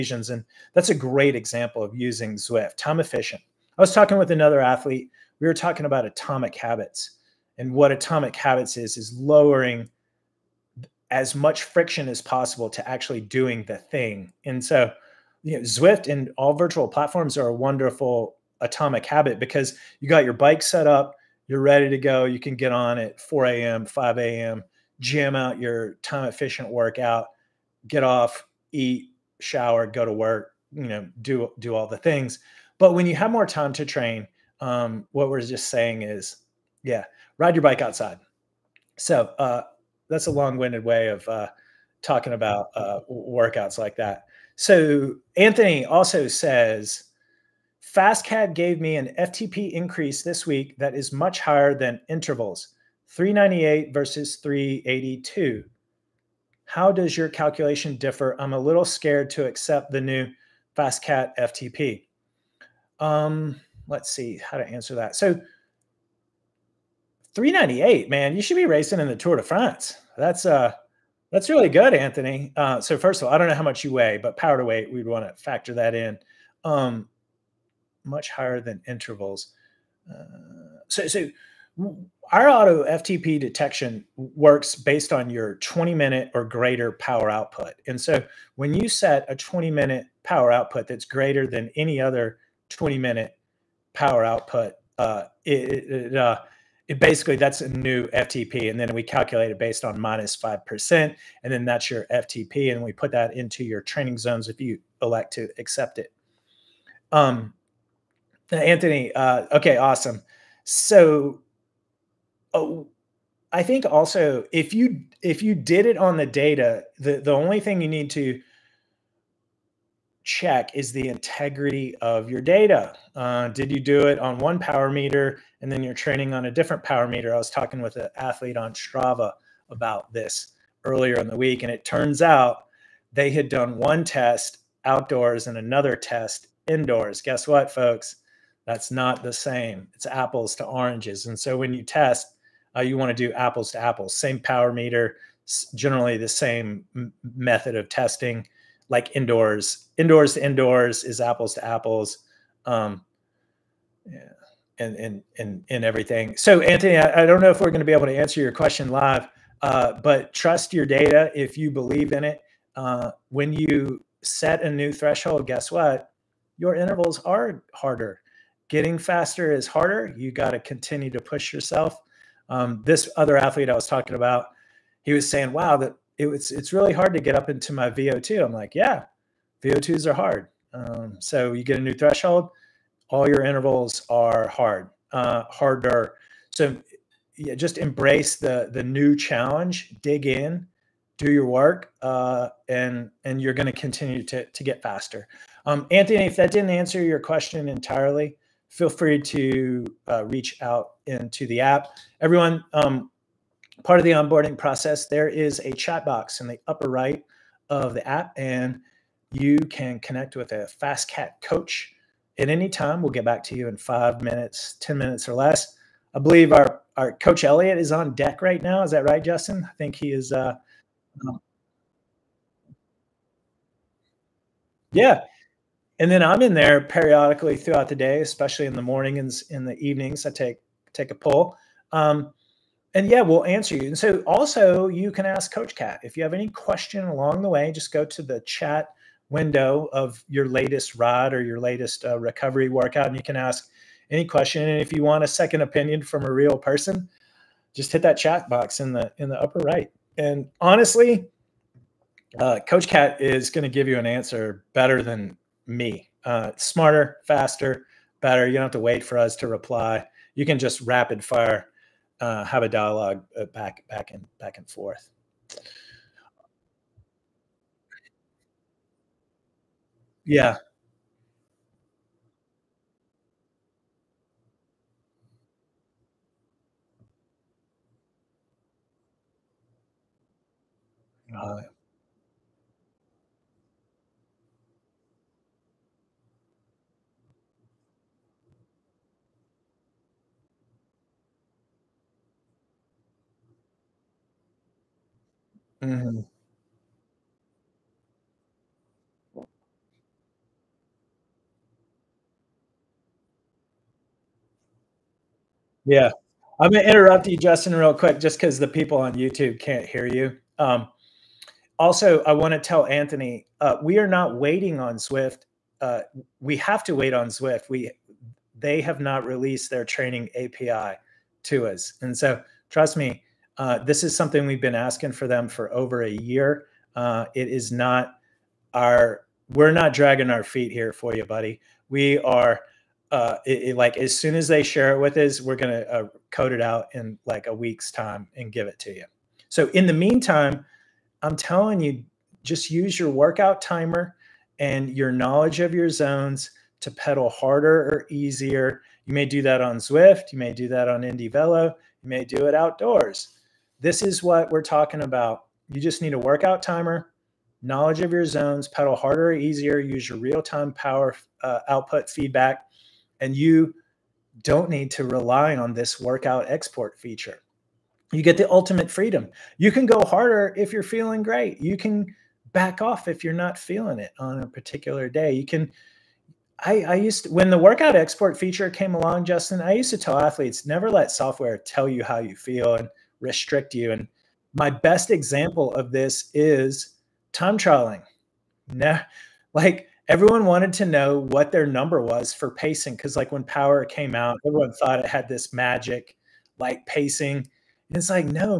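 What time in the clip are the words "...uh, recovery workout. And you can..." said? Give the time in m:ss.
4:02.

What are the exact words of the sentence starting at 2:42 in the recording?
Uh, when you set a new threshold, guess what?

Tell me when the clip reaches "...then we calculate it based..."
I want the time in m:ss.
1:38.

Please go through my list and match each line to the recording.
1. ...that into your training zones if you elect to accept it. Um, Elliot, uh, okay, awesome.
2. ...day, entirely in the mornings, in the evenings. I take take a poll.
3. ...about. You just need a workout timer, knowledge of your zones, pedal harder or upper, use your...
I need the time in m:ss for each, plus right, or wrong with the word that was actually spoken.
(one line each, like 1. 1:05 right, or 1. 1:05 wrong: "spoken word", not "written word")
1. 1:43 wrong: "Anthony", not "Elliot"
2. 3:47 wrong: "especially", not "entirely"
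3. 5:55 wrong: "easier", not "upper".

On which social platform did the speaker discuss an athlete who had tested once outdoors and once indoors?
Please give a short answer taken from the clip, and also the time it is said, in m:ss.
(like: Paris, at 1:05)
Strava, at 2:08.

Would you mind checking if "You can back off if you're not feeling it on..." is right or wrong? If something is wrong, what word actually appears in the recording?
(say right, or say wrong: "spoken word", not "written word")
right.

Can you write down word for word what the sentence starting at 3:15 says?
Um, Anthony, if that didn't answer your question entirely, feel free to uh, reach out into the app.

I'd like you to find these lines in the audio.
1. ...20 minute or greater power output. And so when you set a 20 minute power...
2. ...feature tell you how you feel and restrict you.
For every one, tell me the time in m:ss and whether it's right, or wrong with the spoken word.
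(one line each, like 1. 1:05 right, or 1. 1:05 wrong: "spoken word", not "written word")
1. 1:25 right
2. 6:21 wrong: "software", not "feature".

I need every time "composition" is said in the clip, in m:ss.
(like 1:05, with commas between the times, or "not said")
not said.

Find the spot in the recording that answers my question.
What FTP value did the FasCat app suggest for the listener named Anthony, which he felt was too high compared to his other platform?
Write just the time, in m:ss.
0:53.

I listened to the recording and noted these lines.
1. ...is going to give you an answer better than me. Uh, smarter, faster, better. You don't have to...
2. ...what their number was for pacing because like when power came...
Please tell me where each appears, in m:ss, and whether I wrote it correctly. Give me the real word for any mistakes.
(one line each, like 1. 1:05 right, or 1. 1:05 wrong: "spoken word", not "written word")
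1. 4:13 right
2. 6:31 right.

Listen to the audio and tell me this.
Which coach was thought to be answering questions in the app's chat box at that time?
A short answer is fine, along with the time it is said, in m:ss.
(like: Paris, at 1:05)
Elliot, at 3:37.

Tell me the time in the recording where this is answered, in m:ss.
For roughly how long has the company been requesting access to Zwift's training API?
5:25.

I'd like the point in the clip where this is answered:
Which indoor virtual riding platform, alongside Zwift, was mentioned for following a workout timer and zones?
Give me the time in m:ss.
5:51.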